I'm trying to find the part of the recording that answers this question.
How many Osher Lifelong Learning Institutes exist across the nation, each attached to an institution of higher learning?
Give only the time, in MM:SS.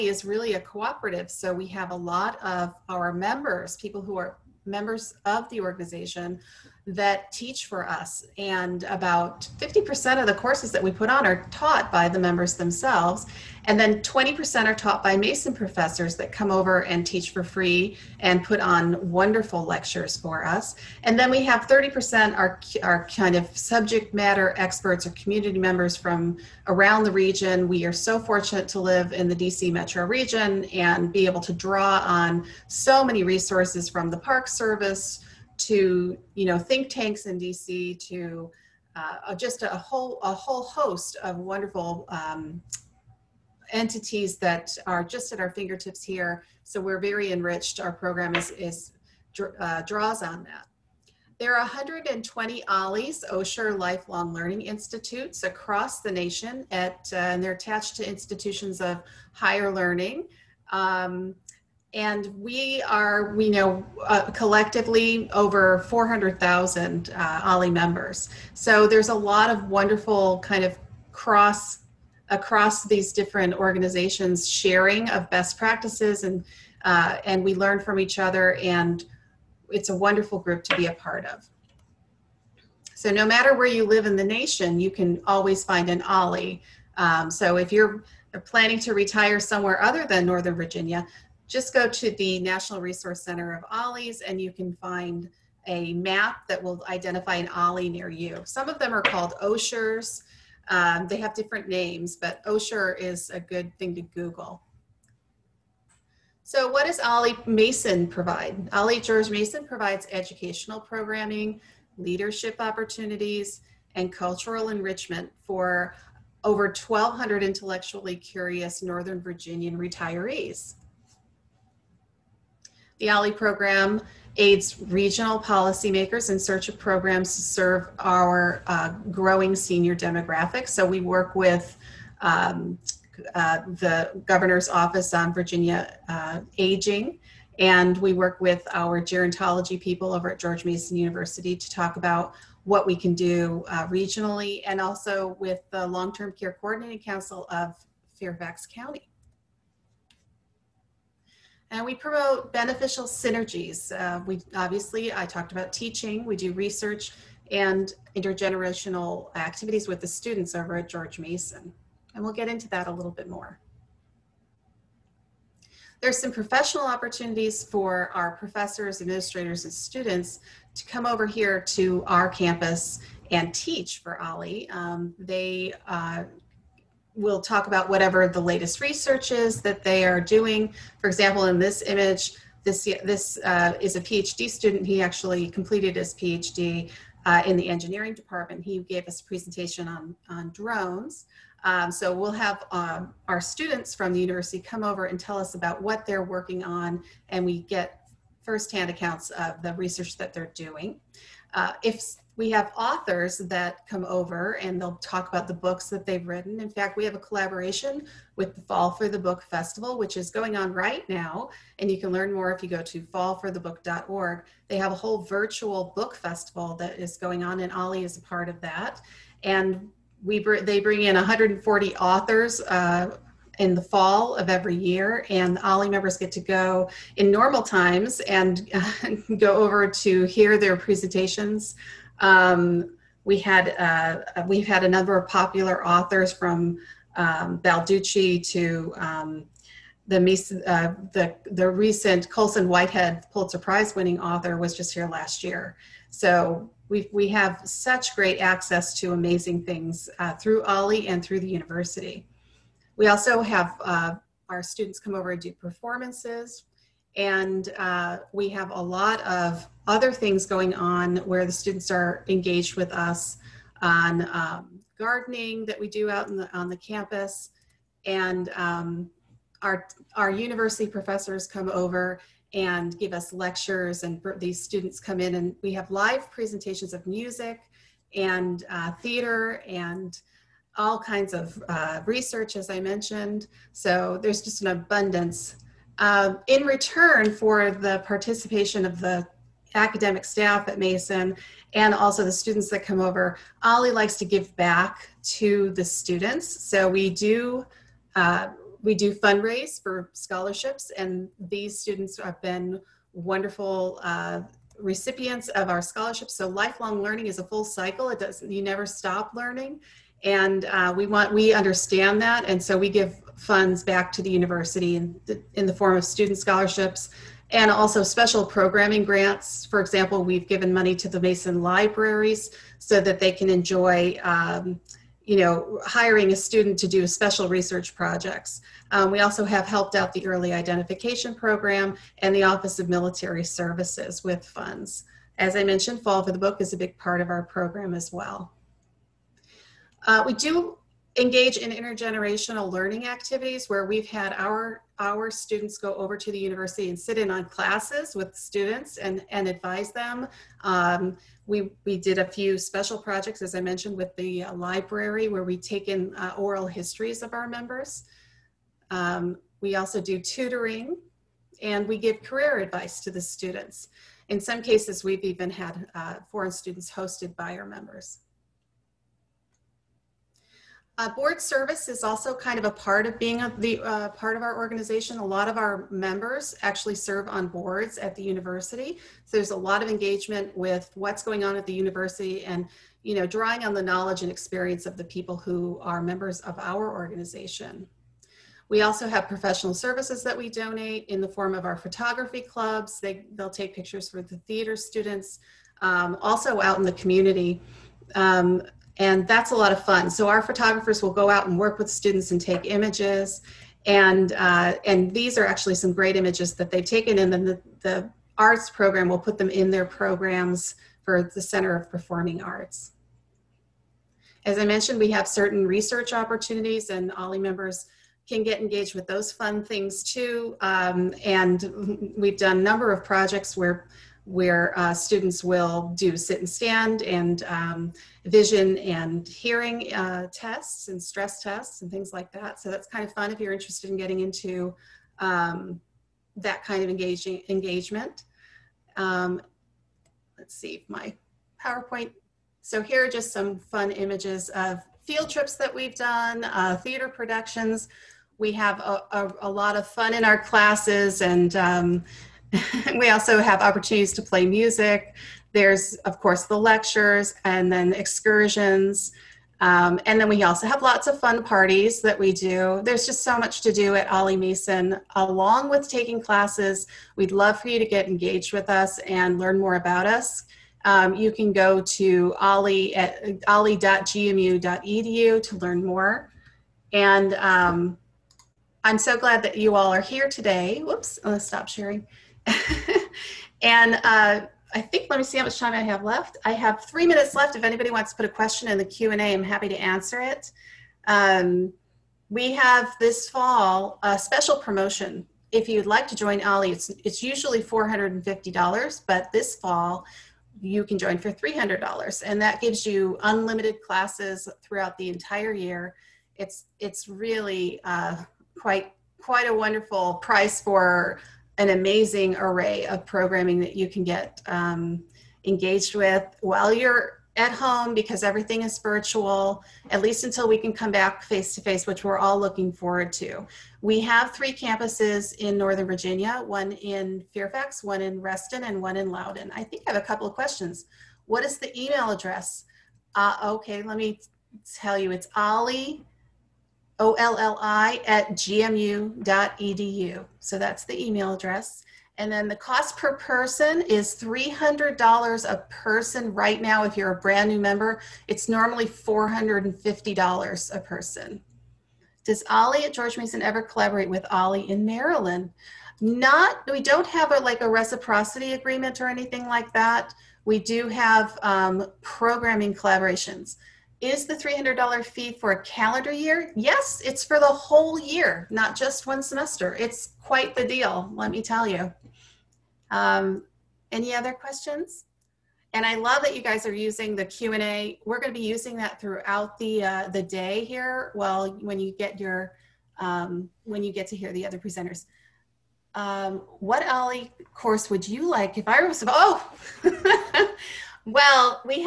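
00:51.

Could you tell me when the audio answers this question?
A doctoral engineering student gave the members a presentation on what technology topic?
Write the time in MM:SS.
03:10.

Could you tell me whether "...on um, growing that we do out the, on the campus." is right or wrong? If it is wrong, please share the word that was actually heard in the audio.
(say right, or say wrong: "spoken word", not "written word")
wrong: "gardening", not "growing".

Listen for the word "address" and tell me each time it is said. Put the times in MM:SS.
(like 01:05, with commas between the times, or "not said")
08:52, 09:01.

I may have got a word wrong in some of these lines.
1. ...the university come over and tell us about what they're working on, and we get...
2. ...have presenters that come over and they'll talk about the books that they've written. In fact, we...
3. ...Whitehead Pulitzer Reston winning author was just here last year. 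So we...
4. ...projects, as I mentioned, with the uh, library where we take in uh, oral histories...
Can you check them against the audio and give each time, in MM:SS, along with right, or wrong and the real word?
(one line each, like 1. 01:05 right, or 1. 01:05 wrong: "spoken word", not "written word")
1. 03:14 right
2. 03:22 wrong: "authors", not "presenters"
3. 04:02 wrong: "Prize", not "Reston"
4. 05:52 right.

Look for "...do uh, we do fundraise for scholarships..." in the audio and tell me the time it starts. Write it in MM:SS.
04:57.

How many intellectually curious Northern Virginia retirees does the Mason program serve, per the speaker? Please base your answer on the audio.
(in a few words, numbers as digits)
over 1,200.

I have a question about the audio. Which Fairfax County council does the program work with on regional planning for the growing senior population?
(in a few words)
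Long Term Care Coordinating Council.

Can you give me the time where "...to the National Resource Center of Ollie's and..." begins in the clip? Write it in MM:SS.
01:31.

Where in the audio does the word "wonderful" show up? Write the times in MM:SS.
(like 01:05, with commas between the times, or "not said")
00:19, 00:41, 01:09, 01:19, 05:03, 08:29.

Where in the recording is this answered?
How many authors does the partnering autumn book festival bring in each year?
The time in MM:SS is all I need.
03:41.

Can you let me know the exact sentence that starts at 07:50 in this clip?
Um, you can go to ollie at ollie.gmu.edu to learn more.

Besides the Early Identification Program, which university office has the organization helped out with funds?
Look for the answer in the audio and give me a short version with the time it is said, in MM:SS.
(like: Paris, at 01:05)
Office of Military Services, at 05:32.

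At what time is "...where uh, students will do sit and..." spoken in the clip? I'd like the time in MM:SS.
07:04.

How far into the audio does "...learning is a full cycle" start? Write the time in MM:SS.
05:07.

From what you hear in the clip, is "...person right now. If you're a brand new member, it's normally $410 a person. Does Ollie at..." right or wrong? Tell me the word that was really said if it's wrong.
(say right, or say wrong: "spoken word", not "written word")
wrong: "450", not "410".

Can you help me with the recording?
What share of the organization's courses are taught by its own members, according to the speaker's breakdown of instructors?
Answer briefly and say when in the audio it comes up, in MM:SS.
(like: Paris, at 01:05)
50%, at 00:08.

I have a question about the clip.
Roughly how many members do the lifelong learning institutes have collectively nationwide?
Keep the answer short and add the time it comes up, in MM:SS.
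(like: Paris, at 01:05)
over 400000, at 01:05.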